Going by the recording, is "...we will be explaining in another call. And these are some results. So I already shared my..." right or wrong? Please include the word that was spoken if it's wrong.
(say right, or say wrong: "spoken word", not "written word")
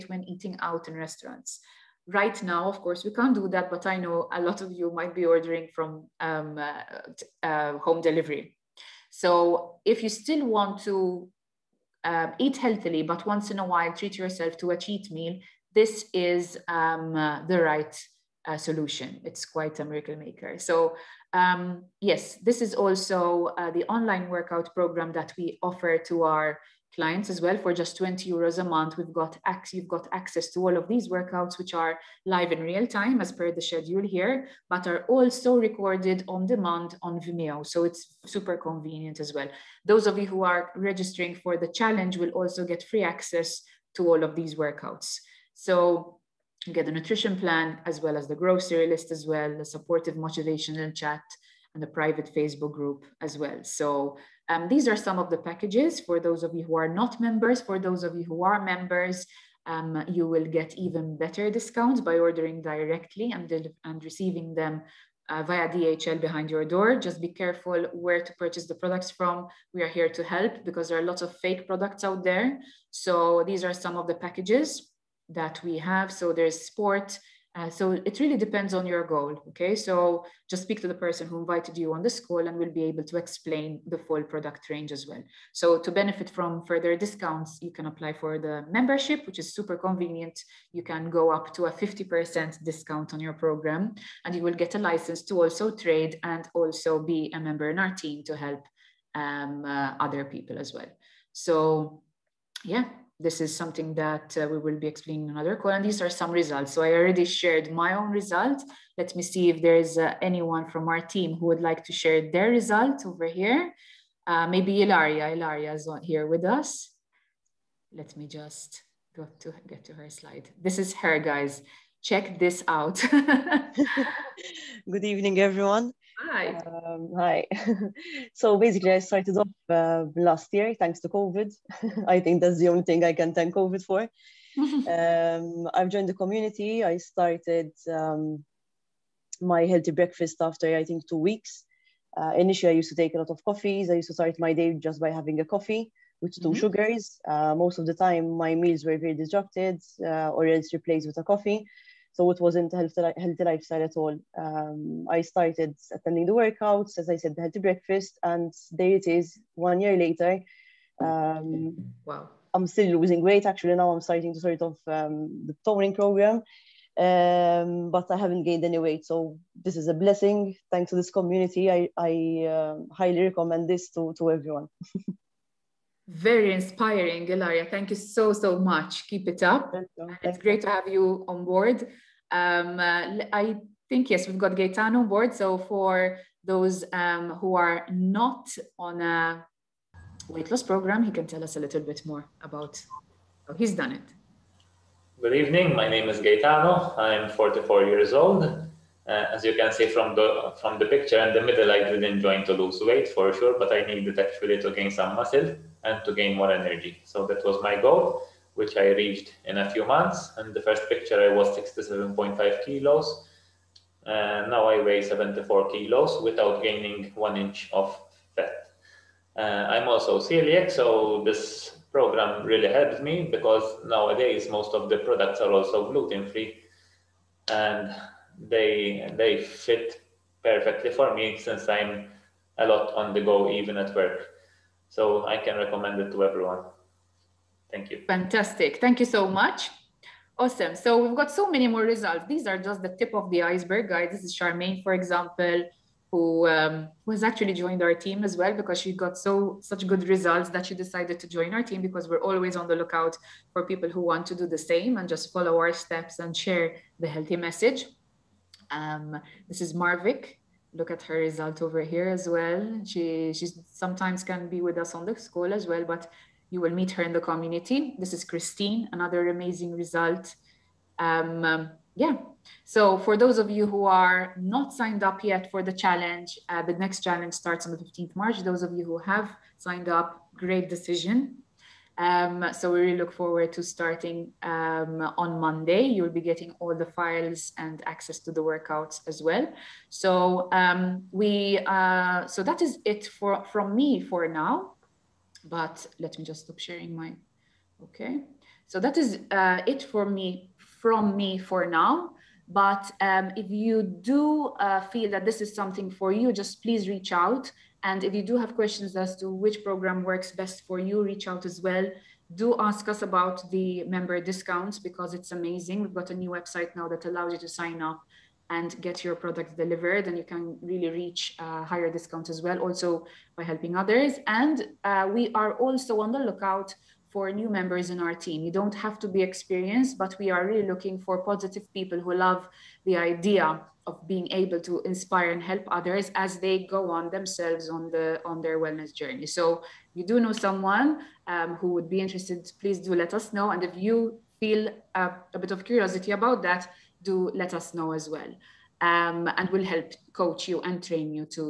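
right.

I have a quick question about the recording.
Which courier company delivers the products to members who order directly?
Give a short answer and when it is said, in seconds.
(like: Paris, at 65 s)
DHL, at 65 s.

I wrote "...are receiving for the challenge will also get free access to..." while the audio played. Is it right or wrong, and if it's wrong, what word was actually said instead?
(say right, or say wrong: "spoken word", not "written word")
wrong: "registering", not "receiving".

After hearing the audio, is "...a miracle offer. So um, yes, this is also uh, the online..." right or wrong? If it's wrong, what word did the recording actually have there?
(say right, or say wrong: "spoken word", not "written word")
wrong: "maker", not "offer".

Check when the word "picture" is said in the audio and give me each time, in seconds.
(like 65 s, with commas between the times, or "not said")
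200 s, 210 s.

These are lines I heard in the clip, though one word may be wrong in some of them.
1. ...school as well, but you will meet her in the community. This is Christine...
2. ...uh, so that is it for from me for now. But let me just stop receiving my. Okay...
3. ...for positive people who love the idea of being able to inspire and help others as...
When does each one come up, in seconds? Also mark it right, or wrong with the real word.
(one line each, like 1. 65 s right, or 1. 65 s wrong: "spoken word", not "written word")
1. 265 s right
2. 291 s wrong: "sharing", not "receiving"
3. 331 s right.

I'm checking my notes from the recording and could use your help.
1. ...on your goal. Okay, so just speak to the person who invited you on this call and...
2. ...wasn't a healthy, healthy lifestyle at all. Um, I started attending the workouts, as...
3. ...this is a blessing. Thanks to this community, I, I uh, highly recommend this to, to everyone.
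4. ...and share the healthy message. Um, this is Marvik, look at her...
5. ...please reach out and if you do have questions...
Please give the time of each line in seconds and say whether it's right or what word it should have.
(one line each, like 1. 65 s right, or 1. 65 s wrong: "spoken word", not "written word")
1. 78 s right
2. 152 s right
3. 169 s right
4. 256 s right
5. 306 s right.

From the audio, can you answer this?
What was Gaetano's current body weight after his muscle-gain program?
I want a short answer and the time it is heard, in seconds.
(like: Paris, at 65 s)
74 kilos, at 215 s.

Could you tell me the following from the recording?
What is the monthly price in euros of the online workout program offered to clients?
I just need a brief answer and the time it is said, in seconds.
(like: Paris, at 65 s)
20 euros, at 27 s.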